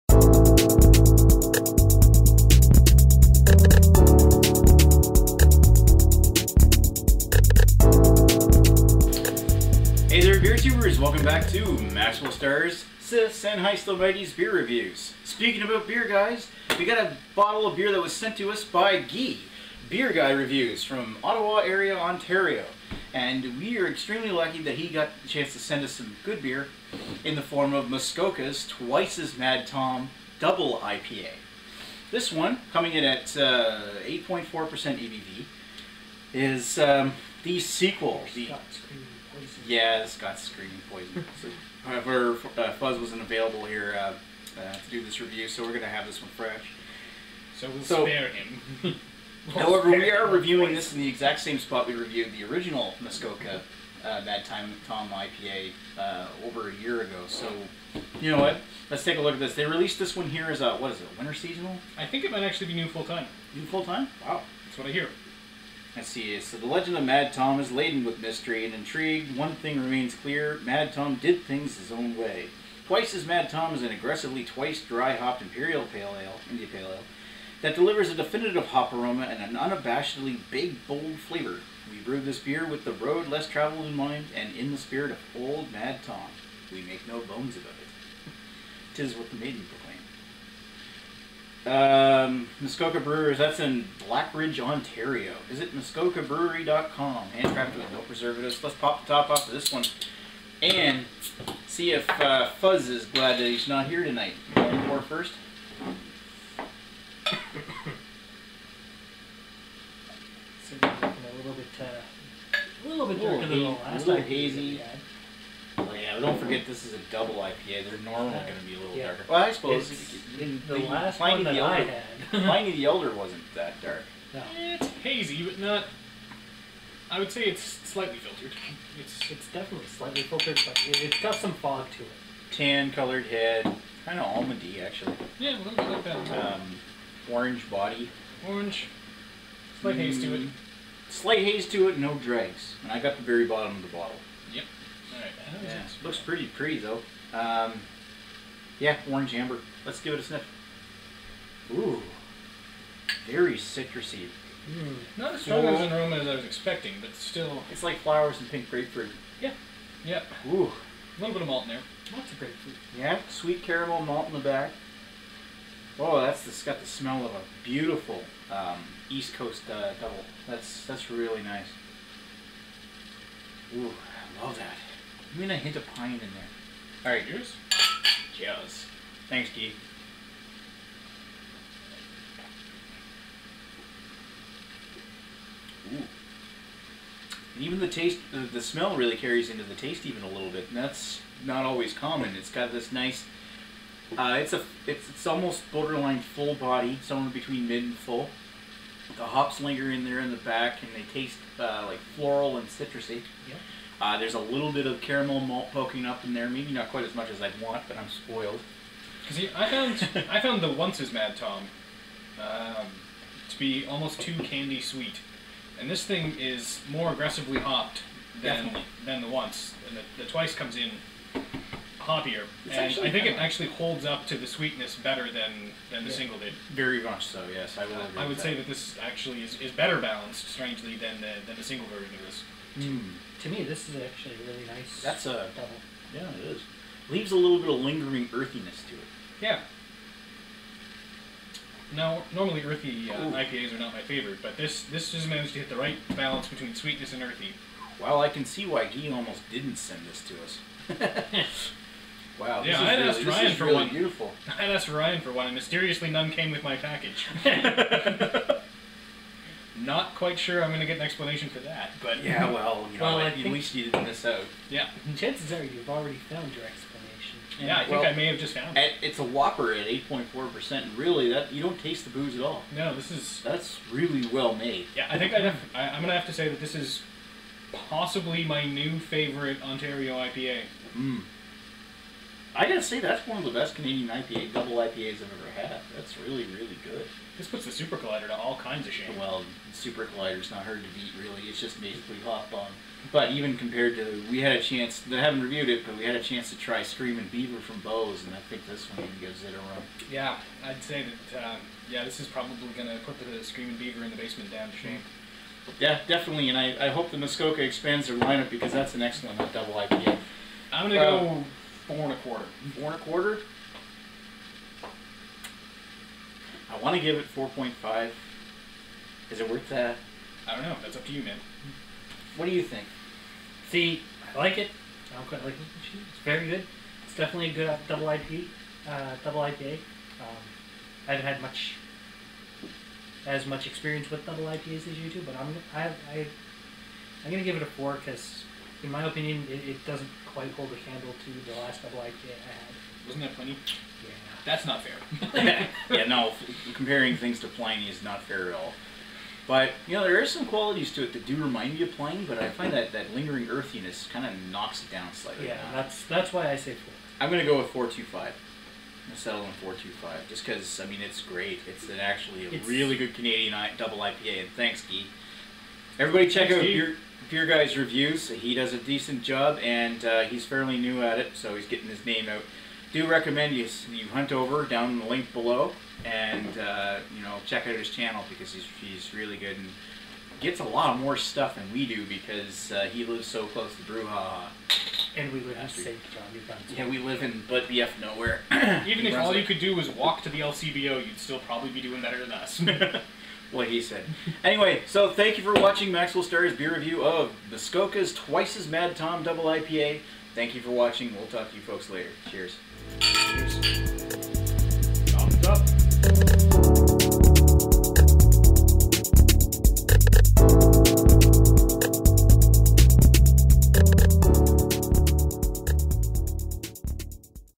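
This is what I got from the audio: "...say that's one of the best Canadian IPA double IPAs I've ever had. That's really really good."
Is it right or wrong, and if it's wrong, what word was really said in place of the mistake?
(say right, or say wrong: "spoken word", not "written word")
right.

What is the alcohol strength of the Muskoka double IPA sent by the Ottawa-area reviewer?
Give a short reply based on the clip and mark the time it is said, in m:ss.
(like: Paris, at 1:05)
8.4%, at 0:33.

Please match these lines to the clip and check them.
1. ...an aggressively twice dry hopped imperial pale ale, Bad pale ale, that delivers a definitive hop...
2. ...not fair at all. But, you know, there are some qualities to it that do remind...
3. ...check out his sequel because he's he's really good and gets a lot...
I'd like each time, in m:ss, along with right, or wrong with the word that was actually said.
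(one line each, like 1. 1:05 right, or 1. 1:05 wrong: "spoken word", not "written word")
1. 1:13 wrong: "India", not "Bad"
2. 5:48 right
3. 6:17 wrong: "channel", not "sequel".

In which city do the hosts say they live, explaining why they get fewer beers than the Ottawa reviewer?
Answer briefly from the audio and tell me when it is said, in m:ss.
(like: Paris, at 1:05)
St. John, New Brunswick, at 6:25.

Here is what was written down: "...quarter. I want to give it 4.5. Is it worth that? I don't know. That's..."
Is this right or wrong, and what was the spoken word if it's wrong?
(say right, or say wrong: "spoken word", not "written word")
right.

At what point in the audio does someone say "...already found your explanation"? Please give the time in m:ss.
4:25.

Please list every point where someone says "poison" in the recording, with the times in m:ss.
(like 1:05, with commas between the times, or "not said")
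0:40, 0:50.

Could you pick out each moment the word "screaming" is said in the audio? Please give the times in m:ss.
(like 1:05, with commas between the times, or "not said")
0:40, 4:56, 5:03.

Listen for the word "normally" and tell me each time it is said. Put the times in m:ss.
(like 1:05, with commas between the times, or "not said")
1:57, 4:02.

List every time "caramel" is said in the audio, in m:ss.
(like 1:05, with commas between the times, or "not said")
2:43, 3:24.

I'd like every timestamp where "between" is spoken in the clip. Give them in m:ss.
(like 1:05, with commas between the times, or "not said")
3:17, 4:06.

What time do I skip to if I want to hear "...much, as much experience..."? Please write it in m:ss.
5:31.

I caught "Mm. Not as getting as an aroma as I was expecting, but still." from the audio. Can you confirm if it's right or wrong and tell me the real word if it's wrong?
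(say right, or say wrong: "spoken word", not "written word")
wrong: "strong", not "getting".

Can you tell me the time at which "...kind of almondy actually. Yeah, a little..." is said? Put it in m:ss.
2:14.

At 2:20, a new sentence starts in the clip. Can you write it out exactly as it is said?
Mm, slight haze to it, no dregs.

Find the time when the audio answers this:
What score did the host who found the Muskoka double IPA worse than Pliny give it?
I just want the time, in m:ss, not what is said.
5:37.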